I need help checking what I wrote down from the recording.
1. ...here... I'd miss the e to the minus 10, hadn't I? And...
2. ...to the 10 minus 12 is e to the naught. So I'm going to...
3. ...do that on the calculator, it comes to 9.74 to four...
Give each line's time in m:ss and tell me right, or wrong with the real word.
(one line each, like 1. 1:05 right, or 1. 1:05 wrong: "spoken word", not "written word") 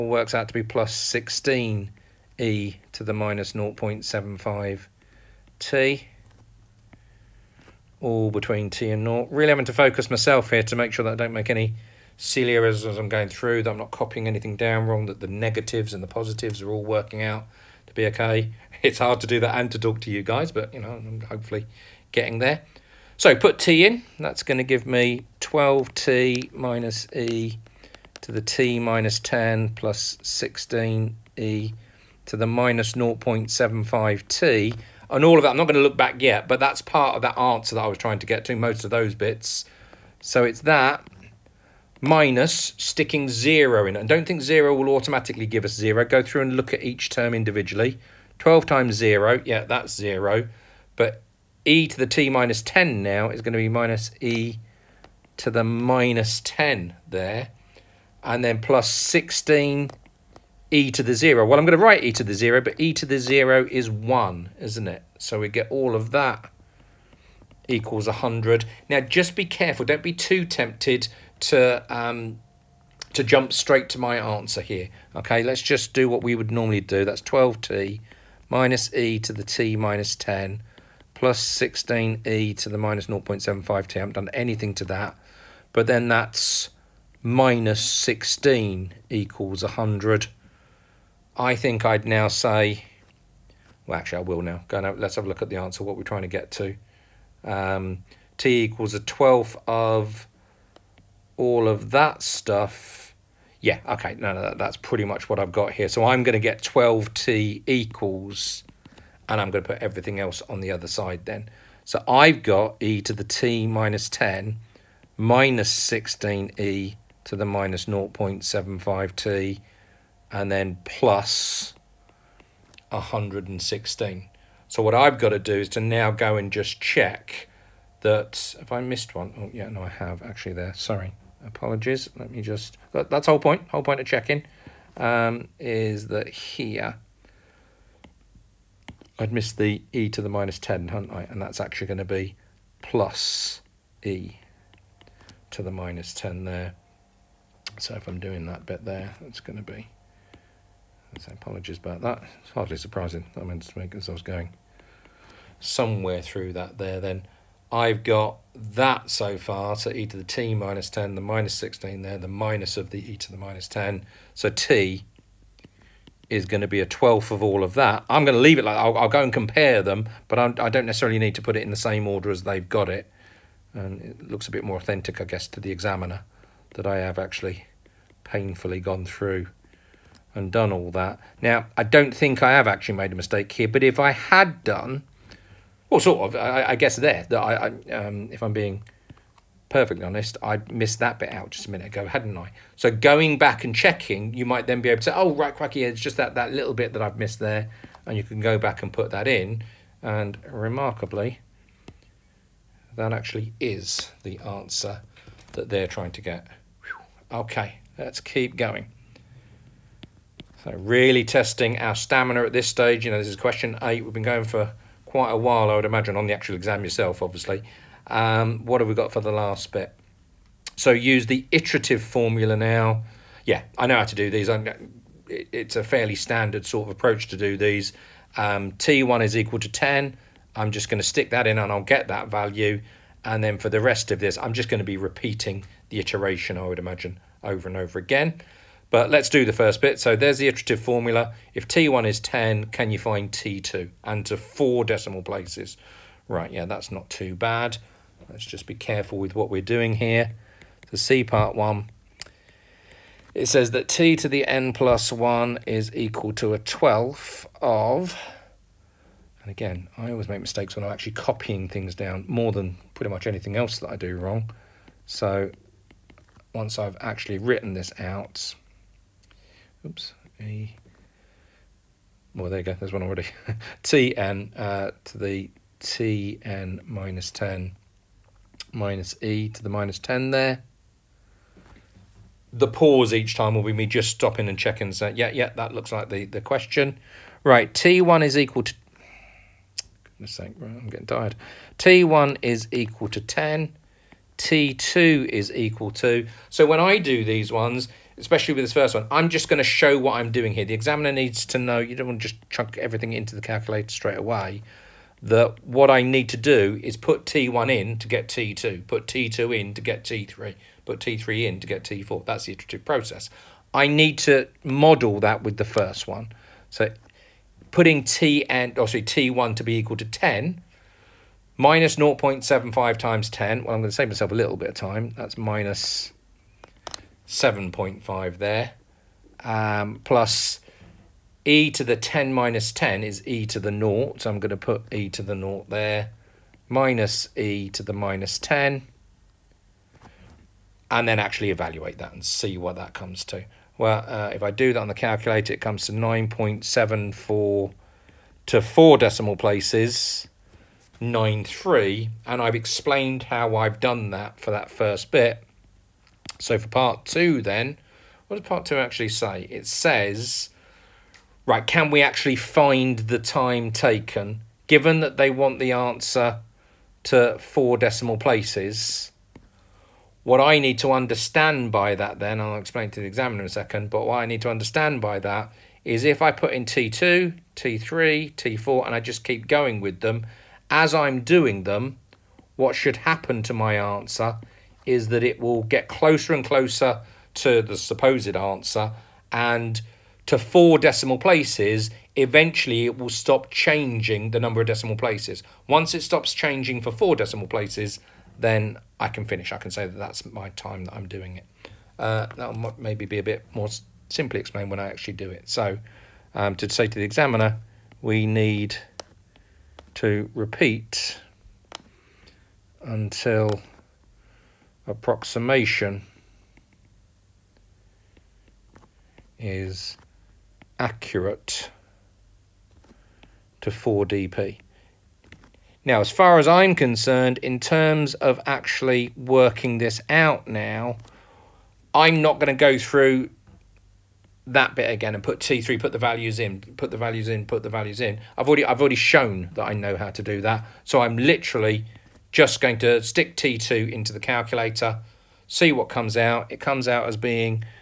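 1. 2:16 right
2. 5:31 wrong: "10", not "12"
3. 5:44 right.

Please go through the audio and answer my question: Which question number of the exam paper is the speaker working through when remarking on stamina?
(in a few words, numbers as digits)
8.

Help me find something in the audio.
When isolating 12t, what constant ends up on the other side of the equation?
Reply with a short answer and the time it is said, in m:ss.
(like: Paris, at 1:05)
116, at 2:02.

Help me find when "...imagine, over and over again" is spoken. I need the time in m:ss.
3:56.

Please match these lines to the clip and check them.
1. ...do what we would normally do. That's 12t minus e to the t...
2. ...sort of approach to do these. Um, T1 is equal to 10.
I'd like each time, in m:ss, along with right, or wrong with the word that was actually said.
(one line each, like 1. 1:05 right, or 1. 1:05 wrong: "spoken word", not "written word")
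1. 1:15 right
2. 3:46 right.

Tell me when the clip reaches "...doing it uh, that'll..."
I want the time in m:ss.
6:41.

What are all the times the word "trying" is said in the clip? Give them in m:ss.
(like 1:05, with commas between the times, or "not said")
0:37, 1:36, 3:25.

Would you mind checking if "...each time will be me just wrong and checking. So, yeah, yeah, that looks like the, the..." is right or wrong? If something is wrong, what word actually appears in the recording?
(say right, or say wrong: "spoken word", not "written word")
wrong: "stopping", not "wrong".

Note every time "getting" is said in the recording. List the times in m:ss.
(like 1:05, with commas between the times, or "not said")
0:22, 4:50.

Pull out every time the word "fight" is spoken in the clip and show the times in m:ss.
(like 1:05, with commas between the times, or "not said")
not said.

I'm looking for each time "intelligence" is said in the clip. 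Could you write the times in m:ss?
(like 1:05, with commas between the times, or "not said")
not said.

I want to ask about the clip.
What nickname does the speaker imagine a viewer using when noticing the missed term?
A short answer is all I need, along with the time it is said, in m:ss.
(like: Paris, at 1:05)
Quacky, at 3:15.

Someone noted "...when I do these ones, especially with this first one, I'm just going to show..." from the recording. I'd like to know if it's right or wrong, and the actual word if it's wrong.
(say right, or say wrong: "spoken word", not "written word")
right.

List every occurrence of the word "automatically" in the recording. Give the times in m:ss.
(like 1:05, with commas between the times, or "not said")
0:44.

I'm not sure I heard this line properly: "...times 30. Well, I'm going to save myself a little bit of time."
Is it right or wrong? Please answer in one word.
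wrong.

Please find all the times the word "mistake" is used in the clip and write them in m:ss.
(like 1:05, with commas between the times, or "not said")
3:03, 4:20.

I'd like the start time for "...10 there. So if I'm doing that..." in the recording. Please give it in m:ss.
2:26.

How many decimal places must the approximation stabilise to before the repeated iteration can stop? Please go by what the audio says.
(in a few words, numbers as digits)
4.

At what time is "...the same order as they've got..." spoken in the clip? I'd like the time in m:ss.
2:51.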